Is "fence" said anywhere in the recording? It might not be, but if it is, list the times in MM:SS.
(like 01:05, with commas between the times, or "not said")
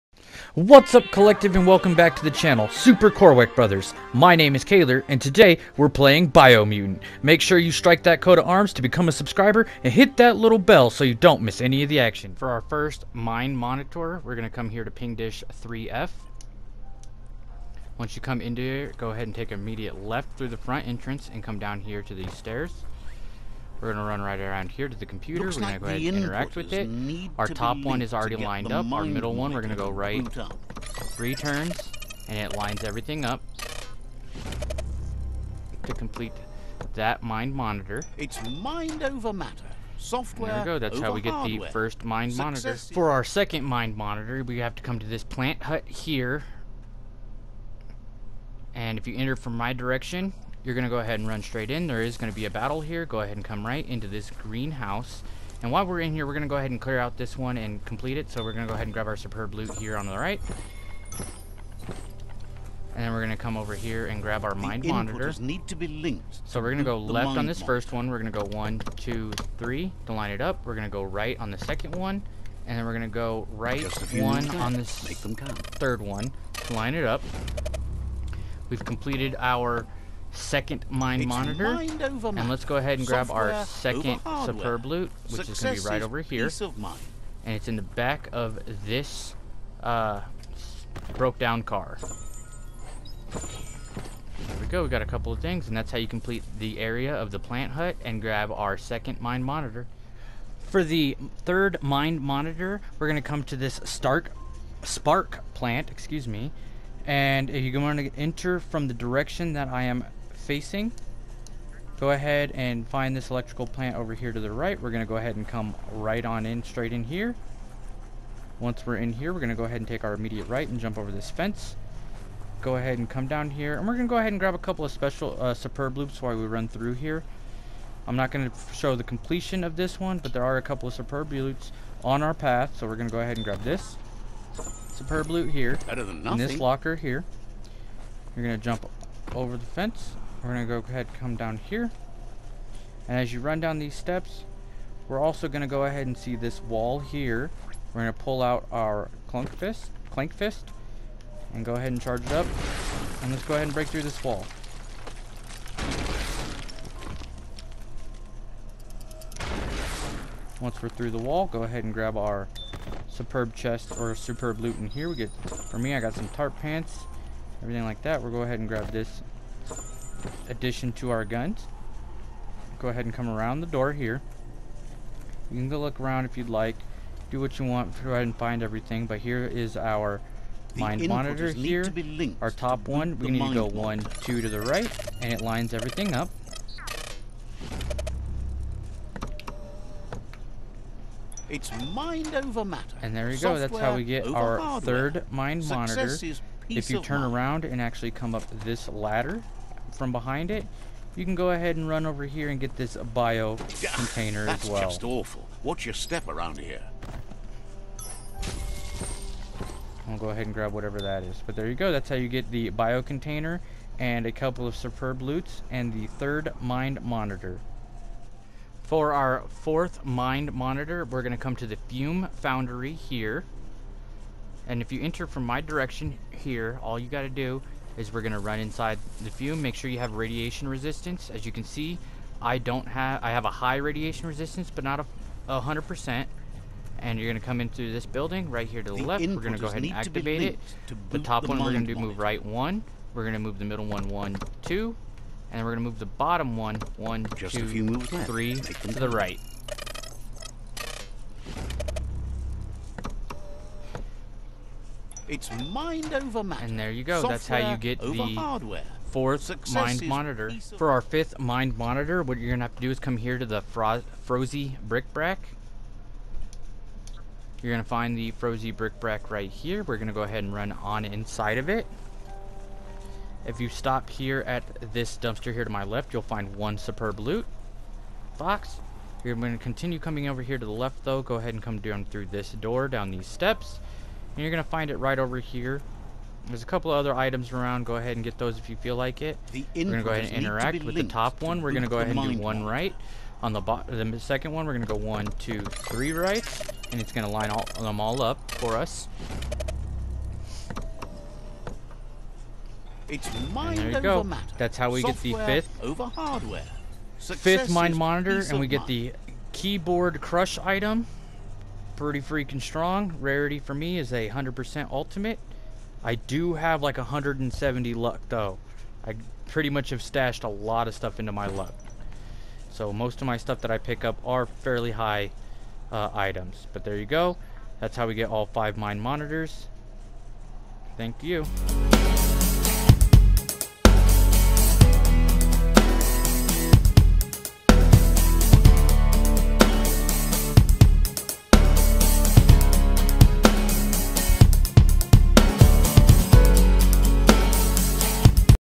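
02:01, 02:19.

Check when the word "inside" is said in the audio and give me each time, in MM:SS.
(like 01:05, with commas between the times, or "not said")
03:48, 04:31.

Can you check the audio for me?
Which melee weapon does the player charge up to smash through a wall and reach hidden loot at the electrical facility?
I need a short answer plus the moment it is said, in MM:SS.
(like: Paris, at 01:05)
Clank fist, at 02:30.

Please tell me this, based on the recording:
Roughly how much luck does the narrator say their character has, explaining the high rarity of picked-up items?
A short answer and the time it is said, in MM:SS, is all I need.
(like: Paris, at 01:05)
170, at 05:16.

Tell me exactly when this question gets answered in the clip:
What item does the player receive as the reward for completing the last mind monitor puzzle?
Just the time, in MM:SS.
05:09.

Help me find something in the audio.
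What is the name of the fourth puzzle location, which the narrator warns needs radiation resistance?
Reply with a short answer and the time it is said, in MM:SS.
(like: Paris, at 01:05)
Fume Foundry, at 03:41.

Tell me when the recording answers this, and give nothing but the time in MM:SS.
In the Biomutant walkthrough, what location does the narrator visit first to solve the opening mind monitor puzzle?
00:14.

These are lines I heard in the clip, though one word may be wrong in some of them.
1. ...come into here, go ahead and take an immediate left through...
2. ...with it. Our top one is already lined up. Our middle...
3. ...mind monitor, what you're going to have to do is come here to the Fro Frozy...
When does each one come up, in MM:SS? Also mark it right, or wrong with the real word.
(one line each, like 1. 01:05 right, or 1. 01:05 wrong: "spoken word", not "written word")
1. 00:18 right
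2. 00:26 right
3. 04:21 right.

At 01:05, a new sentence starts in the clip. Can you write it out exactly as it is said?
Need to be linked so we're going to go left on this first one.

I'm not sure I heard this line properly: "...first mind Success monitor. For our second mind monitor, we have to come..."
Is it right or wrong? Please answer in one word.
right.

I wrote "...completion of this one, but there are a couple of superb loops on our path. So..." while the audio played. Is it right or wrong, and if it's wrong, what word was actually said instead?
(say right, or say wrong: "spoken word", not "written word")
right.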